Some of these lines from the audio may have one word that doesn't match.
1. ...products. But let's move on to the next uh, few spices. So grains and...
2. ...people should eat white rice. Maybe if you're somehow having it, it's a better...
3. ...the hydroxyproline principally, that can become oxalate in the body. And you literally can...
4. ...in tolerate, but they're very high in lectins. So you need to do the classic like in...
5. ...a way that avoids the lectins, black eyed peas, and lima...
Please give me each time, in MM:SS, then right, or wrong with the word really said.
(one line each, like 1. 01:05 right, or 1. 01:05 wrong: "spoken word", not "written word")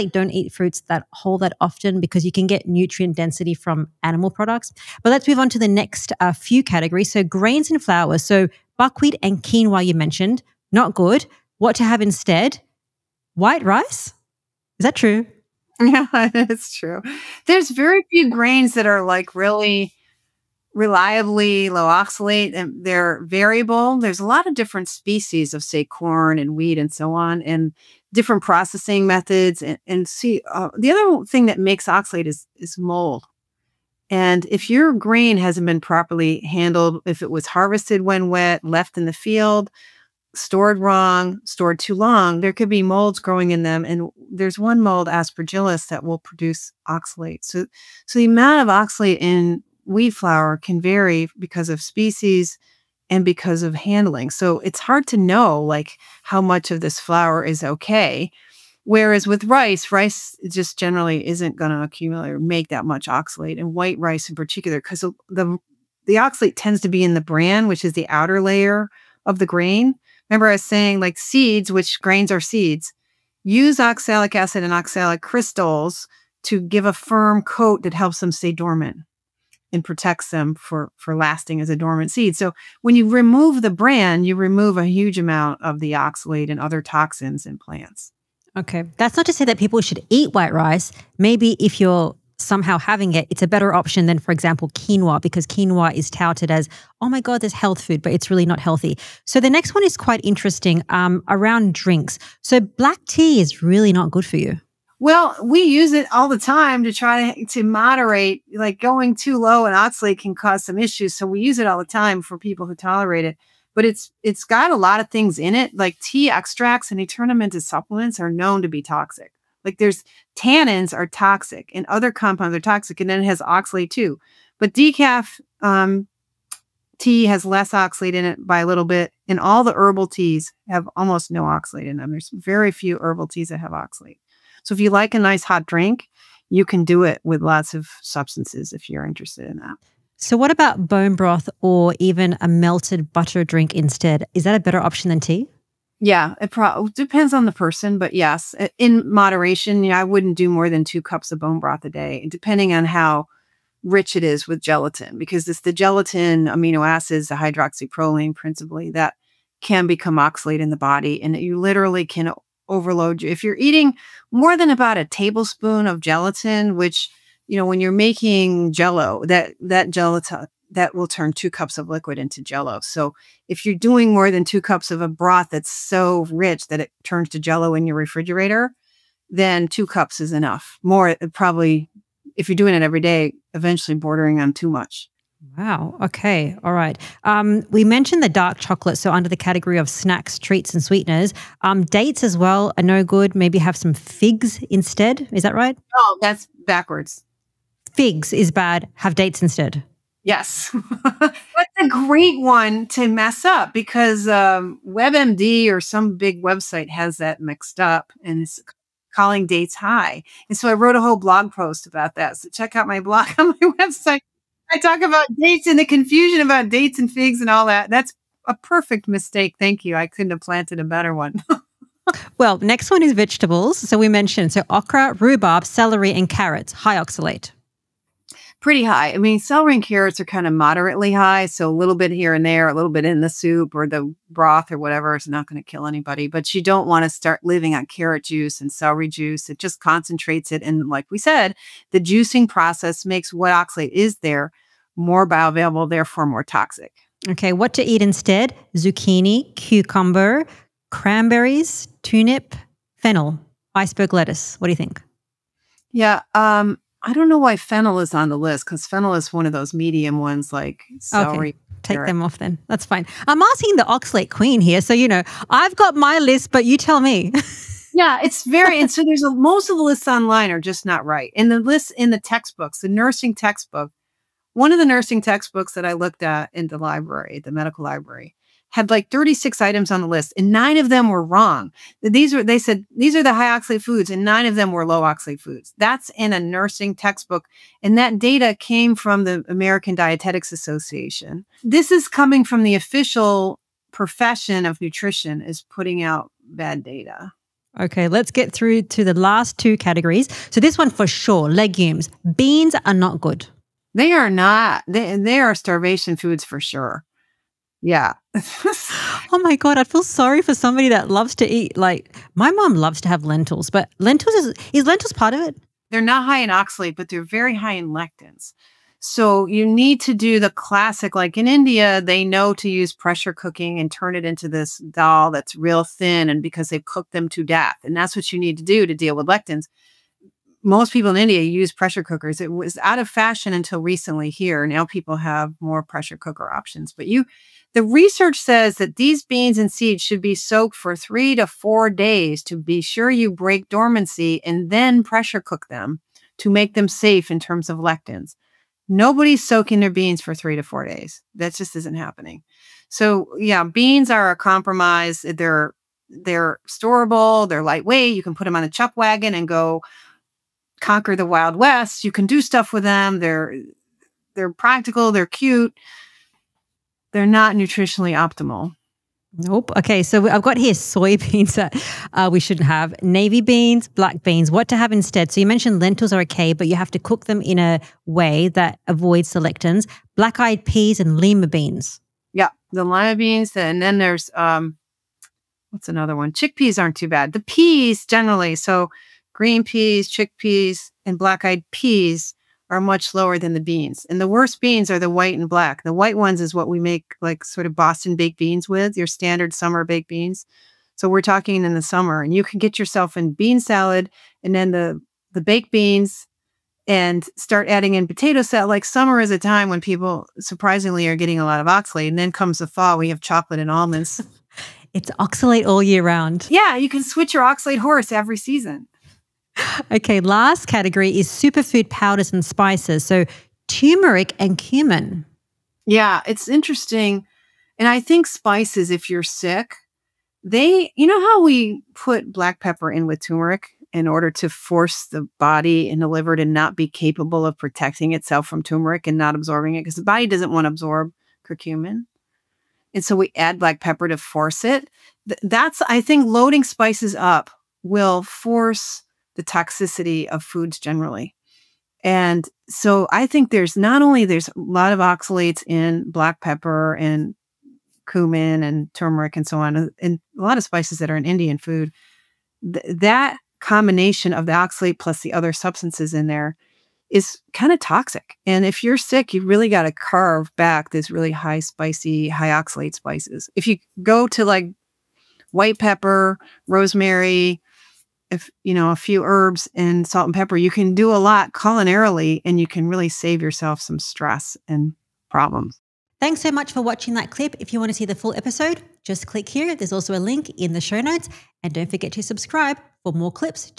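1. 00:04 wrong: "categories", not "spices"
2. 01:29 right
3. 02:37 right
4. 05:16 wrong: "oxalate", not "tolerate"
5. 06:17 right.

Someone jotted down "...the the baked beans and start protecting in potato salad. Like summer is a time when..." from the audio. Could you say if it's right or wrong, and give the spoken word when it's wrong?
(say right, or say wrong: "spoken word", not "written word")
wrong: "adding", not "protecting".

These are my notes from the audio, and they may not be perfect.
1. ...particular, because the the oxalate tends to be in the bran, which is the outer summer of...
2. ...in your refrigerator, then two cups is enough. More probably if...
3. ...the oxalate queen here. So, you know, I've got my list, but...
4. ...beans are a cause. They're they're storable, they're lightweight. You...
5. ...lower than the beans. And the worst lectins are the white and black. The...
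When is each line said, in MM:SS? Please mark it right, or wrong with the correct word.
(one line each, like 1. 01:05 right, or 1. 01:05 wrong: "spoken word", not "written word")
1. 01:04 wrong: "layer", not "summer"
2. 02:57 right
3. 04:23 right
4. 05:53 wrong: "compromise", not "cause"
5. 06:33 wrong: "beans", not "lectins".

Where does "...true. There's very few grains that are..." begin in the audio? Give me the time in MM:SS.
00:16.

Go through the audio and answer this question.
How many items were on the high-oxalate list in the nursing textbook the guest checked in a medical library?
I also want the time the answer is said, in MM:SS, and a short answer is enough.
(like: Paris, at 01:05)
36, at 04:39.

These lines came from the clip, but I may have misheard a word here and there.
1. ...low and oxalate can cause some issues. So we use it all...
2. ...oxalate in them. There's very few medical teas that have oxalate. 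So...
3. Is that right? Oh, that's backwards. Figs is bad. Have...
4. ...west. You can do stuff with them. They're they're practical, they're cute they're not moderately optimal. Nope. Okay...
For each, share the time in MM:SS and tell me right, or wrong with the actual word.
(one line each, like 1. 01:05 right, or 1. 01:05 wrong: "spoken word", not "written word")
1. 01:49 right
2. 02:11 wrong: "herbal", not "medical"
3. 03:15 right
4. 06:01 wrong: "nutritionally", not "moderately".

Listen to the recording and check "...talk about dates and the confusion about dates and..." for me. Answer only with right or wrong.
right.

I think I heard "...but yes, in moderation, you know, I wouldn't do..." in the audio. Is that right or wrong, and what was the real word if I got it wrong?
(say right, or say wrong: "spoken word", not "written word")
right.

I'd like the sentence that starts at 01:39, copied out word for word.
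So the next one is quite interesting um, around drinks.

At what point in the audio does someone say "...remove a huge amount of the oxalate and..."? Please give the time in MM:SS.
01:24.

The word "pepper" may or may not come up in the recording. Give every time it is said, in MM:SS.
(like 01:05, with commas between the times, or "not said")
07:12, 07:23, 07:36, 07:55, 08:00.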